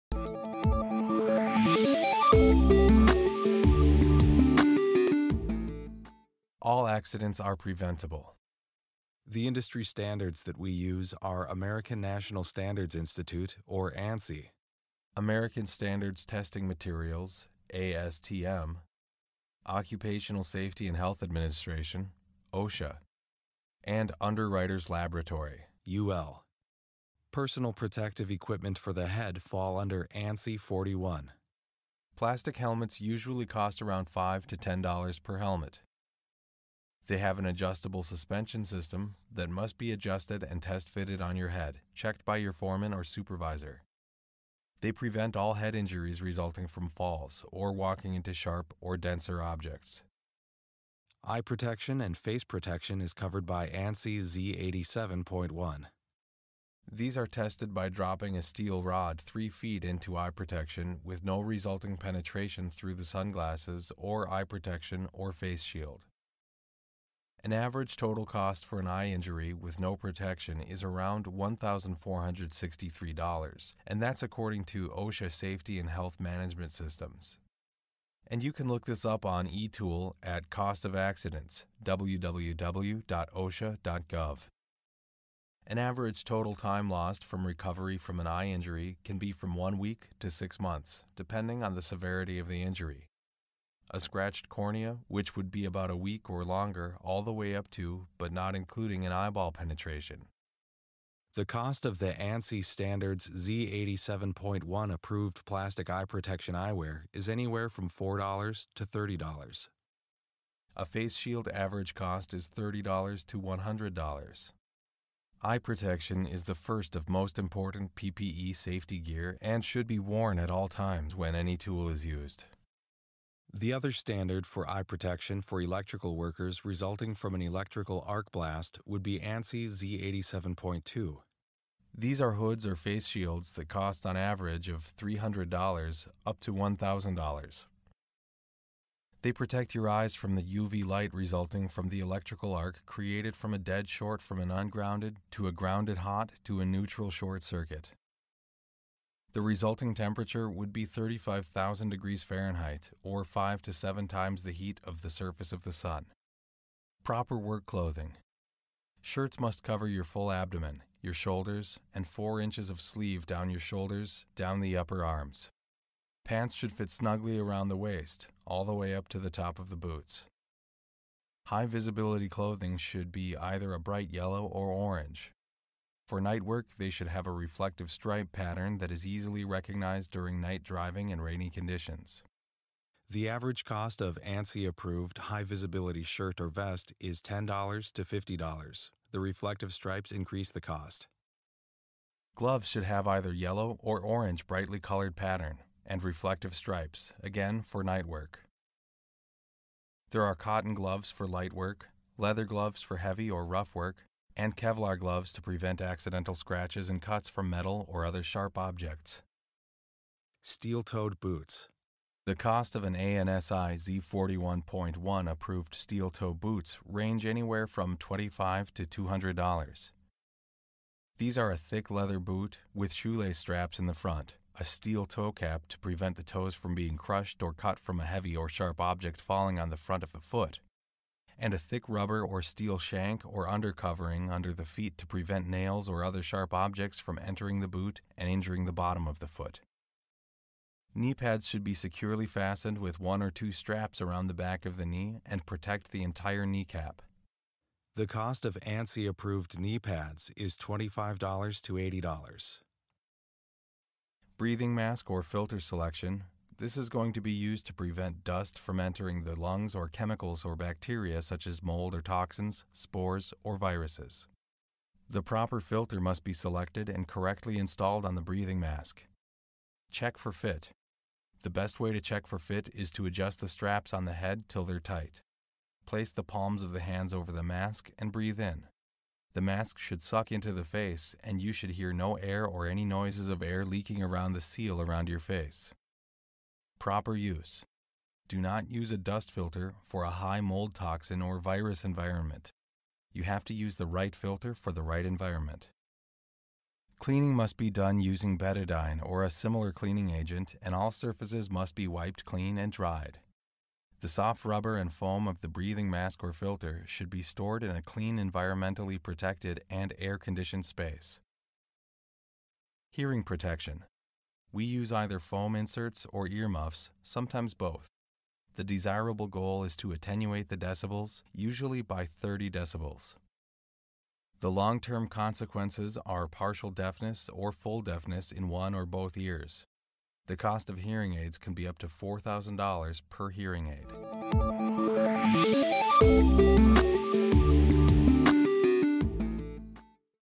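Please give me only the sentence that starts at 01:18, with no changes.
And you can look this up on eTool at Cost of Accidents, www.osha.gov.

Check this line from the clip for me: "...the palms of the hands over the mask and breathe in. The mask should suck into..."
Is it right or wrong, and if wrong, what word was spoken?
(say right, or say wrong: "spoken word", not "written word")
right.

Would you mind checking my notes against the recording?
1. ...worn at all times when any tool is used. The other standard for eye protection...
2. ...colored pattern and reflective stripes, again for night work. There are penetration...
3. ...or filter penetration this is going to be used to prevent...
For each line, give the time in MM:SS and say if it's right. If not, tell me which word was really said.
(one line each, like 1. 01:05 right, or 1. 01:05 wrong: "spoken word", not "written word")
1. 01:59 right
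2. 03:14 wrong: "cotton", not "penetration"
3. 04:15 wrong: "selection", not "penetration".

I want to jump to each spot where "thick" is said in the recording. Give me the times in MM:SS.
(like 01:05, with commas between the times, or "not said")
03:41, 03:51.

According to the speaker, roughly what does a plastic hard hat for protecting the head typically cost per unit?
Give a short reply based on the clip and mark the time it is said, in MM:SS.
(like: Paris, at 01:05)
$5 to $10, at 00:34.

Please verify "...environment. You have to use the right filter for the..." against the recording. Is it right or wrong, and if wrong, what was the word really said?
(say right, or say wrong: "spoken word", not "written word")
right.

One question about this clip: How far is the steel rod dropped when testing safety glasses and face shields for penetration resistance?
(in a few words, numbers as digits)
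3 feet.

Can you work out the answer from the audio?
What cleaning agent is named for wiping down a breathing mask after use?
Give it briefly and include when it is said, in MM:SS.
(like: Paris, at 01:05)
betadine, at 04:58.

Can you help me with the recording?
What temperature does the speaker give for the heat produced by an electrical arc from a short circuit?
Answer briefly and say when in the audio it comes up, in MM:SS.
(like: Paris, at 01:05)
35,000 degrees Fahrenheit, at 02:30.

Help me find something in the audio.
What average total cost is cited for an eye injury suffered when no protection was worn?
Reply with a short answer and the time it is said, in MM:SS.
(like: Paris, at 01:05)
$1,463, at 01:11.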